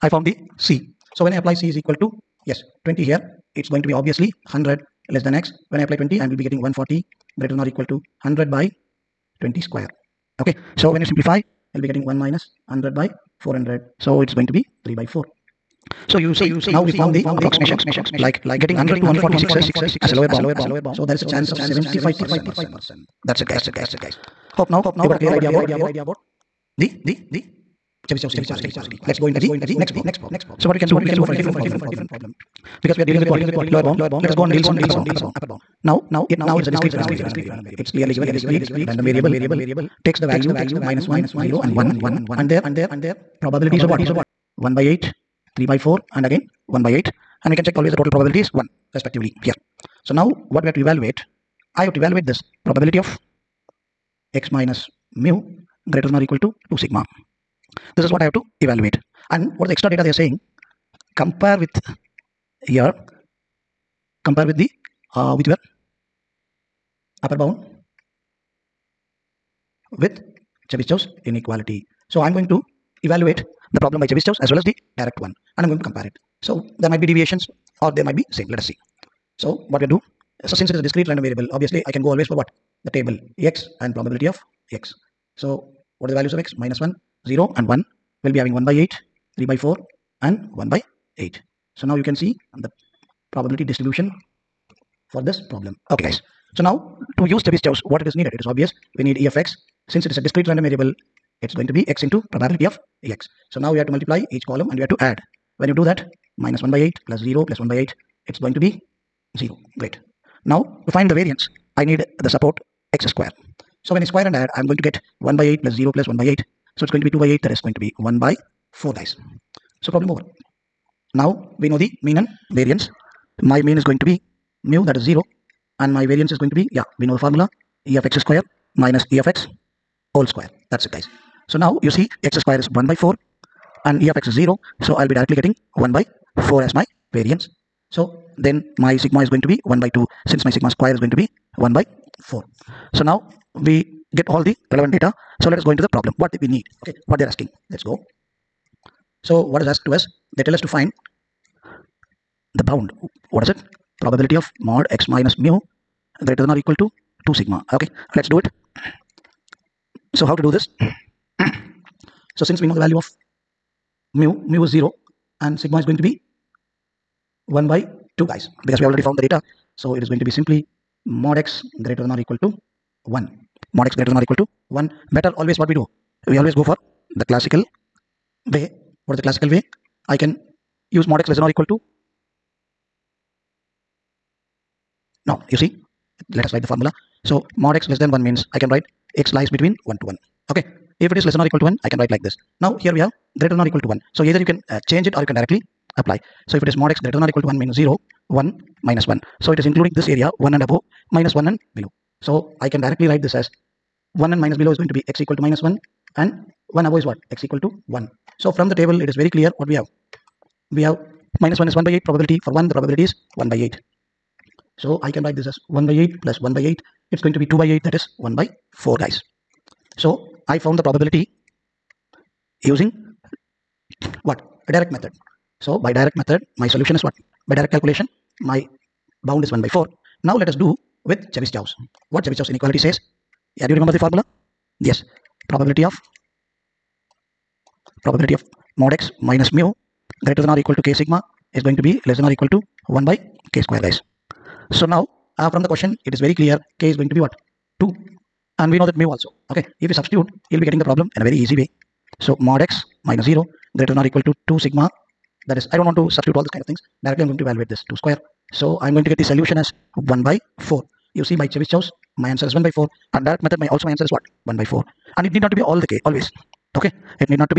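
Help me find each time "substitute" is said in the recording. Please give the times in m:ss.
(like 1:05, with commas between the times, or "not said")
4:09, 4:16.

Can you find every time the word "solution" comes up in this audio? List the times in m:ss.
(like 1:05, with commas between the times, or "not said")
3:46, 4:19.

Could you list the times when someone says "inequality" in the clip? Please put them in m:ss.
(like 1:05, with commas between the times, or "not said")
0:28, 1:11, 3:52.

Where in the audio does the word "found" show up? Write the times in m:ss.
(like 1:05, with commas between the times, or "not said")
0:00, 0:16, 2:49, 3:40.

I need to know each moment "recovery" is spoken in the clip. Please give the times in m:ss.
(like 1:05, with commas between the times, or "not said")
not said.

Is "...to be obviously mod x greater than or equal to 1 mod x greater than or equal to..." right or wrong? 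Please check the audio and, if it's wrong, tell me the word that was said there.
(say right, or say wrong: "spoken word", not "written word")
wrong: "simply", not "obviously".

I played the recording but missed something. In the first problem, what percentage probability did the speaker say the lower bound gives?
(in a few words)
75 percent.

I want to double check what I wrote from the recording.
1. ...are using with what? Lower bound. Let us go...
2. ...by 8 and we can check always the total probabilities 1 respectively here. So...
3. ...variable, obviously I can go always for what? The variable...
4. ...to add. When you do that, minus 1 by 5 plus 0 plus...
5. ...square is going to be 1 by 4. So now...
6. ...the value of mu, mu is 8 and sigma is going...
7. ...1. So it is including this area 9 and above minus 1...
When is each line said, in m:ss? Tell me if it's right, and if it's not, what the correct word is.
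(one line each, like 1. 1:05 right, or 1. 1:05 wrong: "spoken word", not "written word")
1. 0:33 wrong: "dealing", not "using"
2. 0:46 right
3. 1:21 wrong: "table", not "variable"
4. 1:44 wrong: "8", not "5"
5. 2:20 right
6. 2:42 wrong: "0", not "8"
7. 3:19 wrong: "1", not "9".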